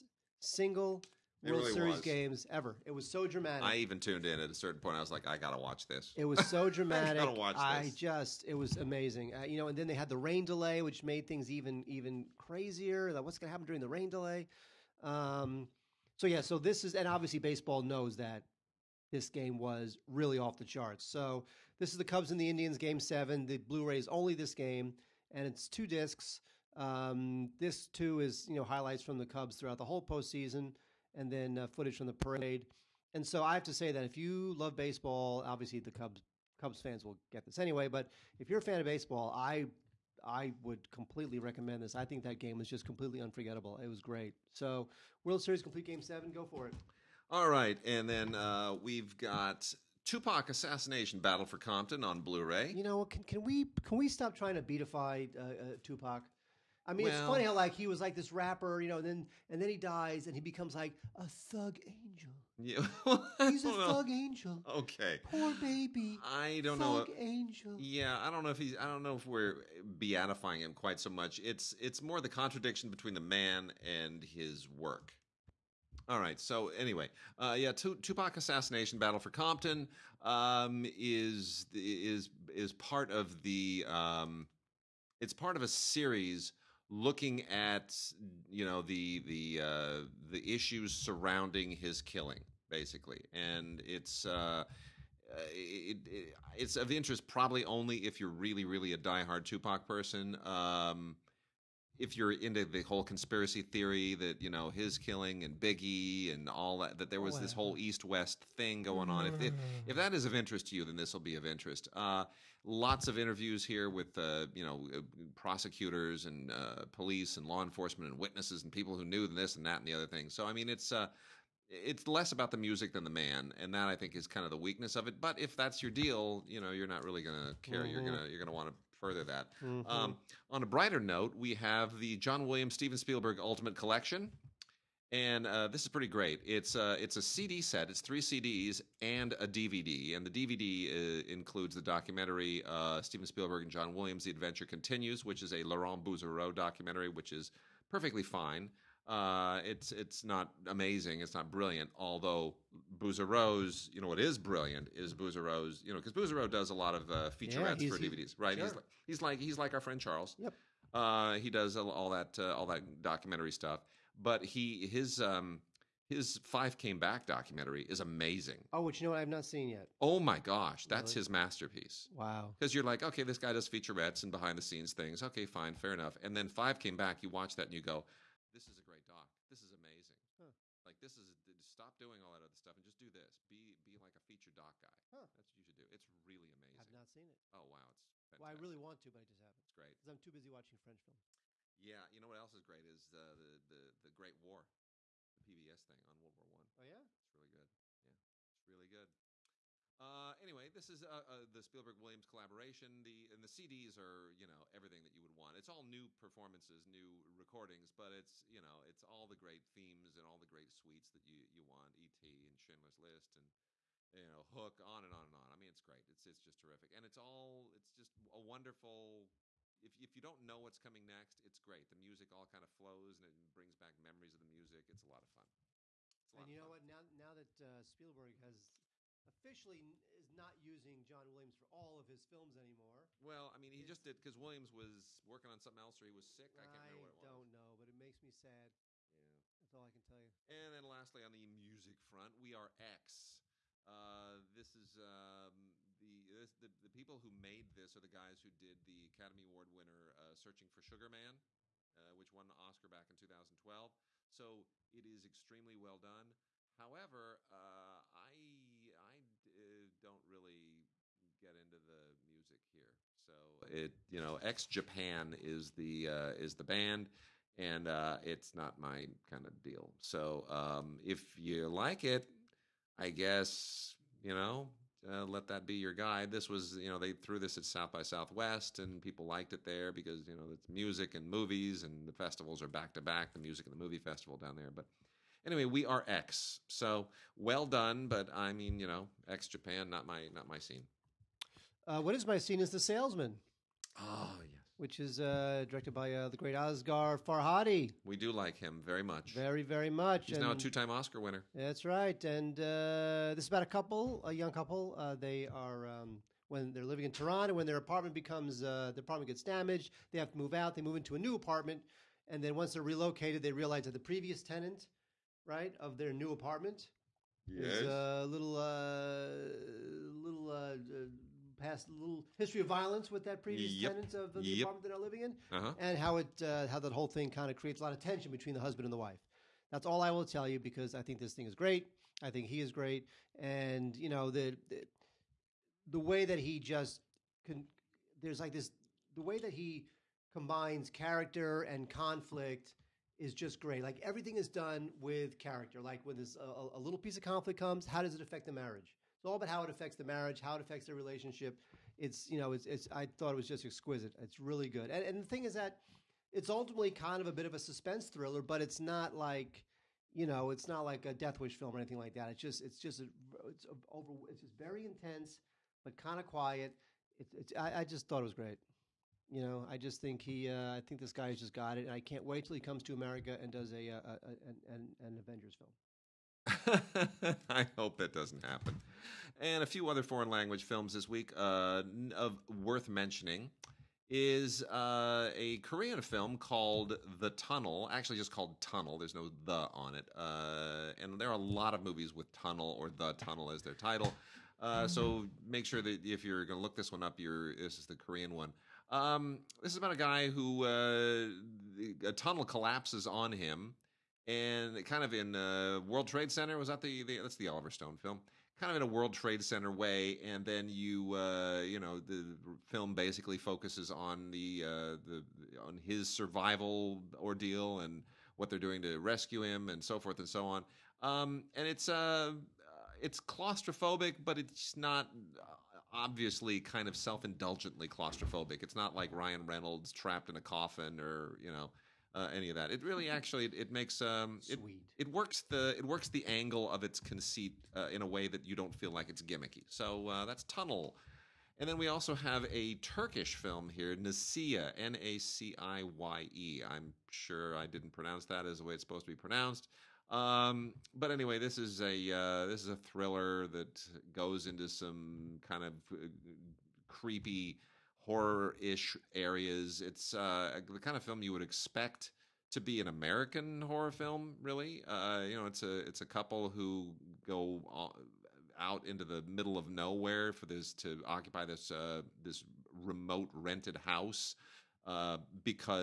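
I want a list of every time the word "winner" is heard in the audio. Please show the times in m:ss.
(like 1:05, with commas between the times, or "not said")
4:09, 5:01.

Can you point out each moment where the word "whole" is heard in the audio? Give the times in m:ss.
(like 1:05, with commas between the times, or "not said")
0:29, 1:42, 1:47, 5:26.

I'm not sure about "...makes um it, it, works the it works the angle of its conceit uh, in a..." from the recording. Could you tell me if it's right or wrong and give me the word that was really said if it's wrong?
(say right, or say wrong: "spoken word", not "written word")
right.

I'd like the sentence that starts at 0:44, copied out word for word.
So World Series complete game seven.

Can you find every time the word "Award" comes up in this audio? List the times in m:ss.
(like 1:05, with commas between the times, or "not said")
4:09.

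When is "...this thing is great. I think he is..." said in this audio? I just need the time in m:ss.
5:31.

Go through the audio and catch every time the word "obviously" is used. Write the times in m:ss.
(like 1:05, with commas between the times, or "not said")
0:17, 0:35, 7:05.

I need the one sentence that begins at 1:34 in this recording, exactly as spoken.
Uh, uh, it, it, it's of interest probably only if you're really, really a diehard Tupac person.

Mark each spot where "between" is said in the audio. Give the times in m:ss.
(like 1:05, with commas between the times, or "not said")
1:12, 5:28.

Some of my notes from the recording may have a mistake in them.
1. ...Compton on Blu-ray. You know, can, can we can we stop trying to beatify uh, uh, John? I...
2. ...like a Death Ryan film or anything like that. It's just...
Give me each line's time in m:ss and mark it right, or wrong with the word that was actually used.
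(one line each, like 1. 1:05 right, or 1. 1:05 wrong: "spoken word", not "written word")
1. 0:51 wrong: "Tupac", not "John"
2. 6:00 wrong: "Wish", not "Ryan".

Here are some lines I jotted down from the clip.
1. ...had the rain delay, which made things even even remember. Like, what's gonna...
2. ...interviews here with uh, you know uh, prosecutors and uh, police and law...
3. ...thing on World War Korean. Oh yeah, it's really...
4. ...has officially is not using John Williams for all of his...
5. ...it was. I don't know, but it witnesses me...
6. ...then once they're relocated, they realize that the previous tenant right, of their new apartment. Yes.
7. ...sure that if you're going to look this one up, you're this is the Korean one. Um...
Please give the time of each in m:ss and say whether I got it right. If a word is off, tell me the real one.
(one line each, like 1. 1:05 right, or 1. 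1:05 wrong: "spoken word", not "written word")
1. 0:09 wrong: "crazier", not "remember"
2. 1:53 right
3. 3:15 wrong: "One", not "Korean"
4. 3:48 right
5. 3:57 wrong: "makes", not "witnesses"
6. 5:12 right
7. 6:35 right.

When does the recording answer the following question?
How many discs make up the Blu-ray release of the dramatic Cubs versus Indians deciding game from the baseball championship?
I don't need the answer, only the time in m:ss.
0:25.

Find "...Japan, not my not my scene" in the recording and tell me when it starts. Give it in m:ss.
4:49.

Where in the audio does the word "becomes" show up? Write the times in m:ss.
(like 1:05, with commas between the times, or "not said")
1:00, 5:08.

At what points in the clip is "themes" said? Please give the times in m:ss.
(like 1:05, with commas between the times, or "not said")
3:29.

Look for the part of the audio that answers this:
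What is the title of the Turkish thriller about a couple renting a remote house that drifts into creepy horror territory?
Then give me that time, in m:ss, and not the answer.
7:23.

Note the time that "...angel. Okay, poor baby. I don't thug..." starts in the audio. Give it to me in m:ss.
1:04.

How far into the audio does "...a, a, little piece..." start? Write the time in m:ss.
5:46.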